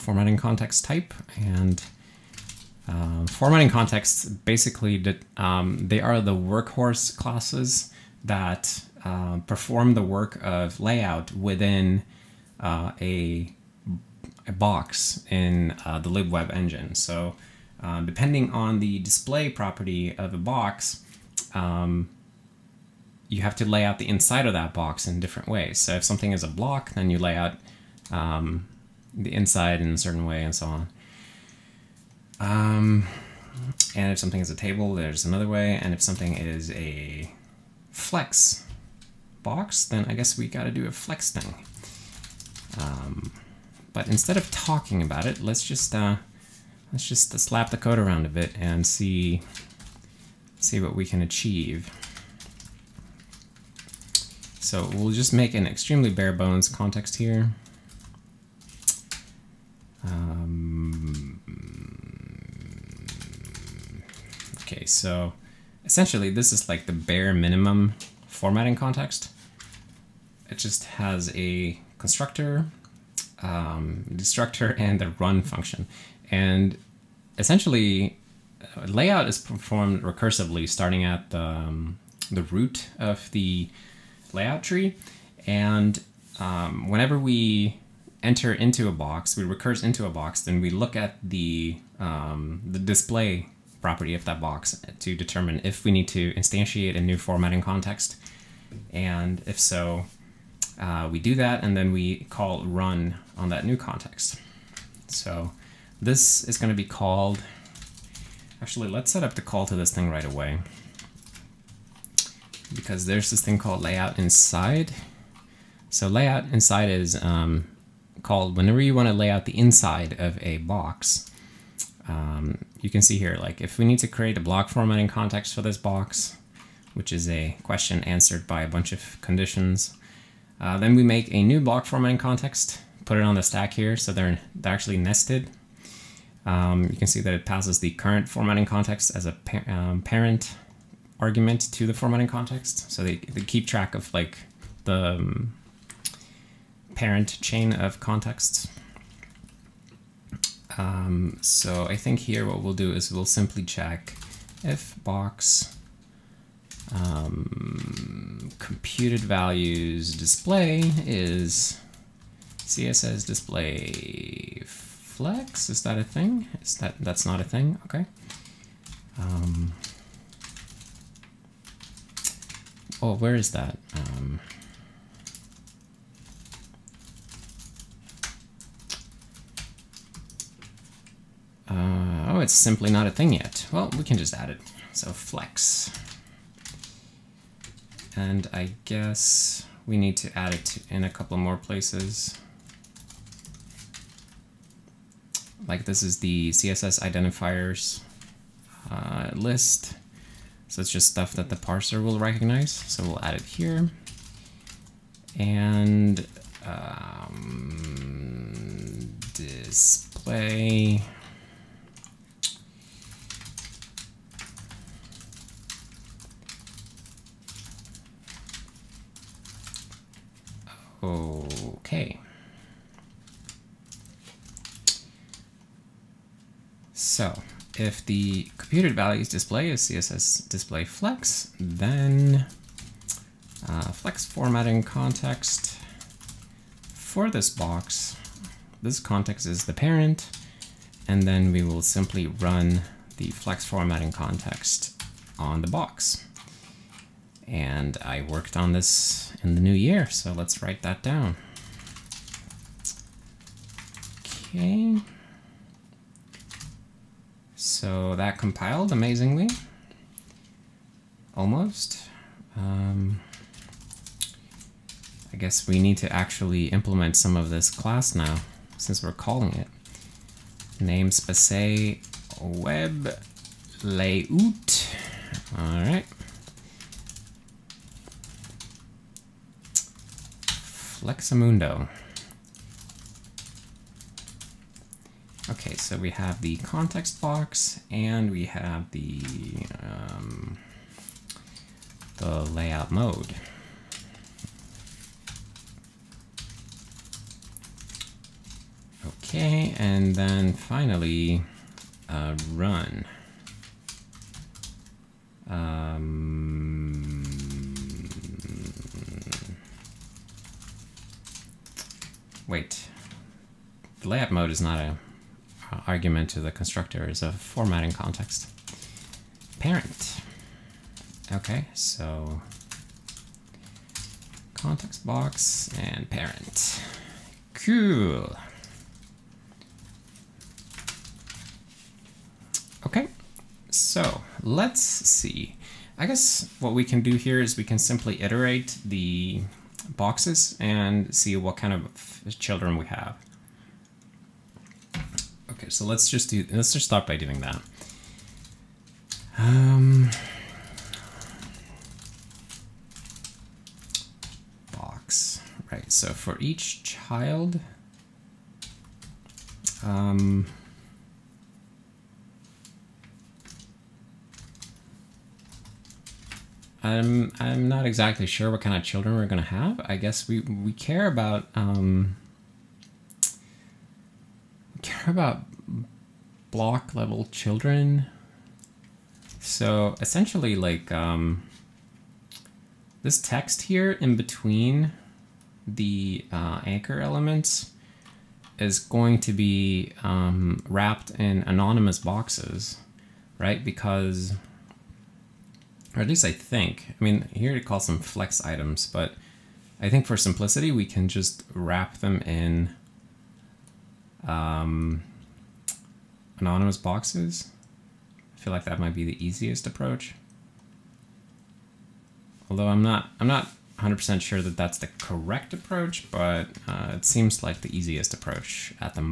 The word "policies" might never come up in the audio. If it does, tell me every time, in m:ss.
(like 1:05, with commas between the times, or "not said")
not said.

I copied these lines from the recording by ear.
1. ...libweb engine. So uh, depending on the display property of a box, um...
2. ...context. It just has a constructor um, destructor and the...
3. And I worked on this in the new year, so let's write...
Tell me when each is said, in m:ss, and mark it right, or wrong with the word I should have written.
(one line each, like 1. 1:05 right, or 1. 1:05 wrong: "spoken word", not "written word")
1. 0:16 right
2. 1:08 right
3. 4:07 right.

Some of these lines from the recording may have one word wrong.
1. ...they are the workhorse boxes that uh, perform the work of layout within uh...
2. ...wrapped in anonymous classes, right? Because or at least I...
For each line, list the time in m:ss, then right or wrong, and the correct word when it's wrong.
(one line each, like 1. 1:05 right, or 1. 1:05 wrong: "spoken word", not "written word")
1. 0:05 wrong: "classes", not "boxes"
2. 6:30 wrong: "boxes", not "classes".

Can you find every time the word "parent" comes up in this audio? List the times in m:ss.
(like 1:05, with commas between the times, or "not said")
2:20, 2:26, 3:59, 5:19, 5:26.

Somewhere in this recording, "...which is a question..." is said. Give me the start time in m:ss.
2:06.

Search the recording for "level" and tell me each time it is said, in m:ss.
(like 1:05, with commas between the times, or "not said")
6:16.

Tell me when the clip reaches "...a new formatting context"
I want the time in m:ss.
1:36.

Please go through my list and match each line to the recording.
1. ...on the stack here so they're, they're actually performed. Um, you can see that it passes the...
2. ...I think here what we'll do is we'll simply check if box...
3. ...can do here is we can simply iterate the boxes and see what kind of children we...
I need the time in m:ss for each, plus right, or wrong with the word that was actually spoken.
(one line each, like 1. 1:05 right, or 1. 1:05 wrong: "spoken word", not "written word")
1. 2:13 wrong: "nested", not "performed"
2. 2:31 right
3. 5:36 right.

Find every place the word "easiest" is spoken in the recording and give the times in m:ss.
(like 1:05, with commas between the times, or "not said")
6:49, 6:57.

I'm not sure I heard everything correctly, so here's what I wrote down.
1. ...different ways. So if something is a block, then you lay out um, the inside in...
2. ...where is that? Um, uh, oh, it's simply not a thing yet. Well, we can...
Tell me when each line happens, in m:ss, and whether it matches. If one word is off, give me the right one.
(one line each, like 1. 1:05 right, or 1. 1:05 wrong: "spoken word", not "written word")
1. 0:25 right
2. 2:53 right.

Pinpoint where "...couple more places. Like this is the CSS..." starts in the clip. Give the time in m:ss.
3:11.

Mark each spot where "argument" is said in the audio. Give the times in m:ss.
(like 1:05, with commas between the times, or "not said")
2:21, 5:15.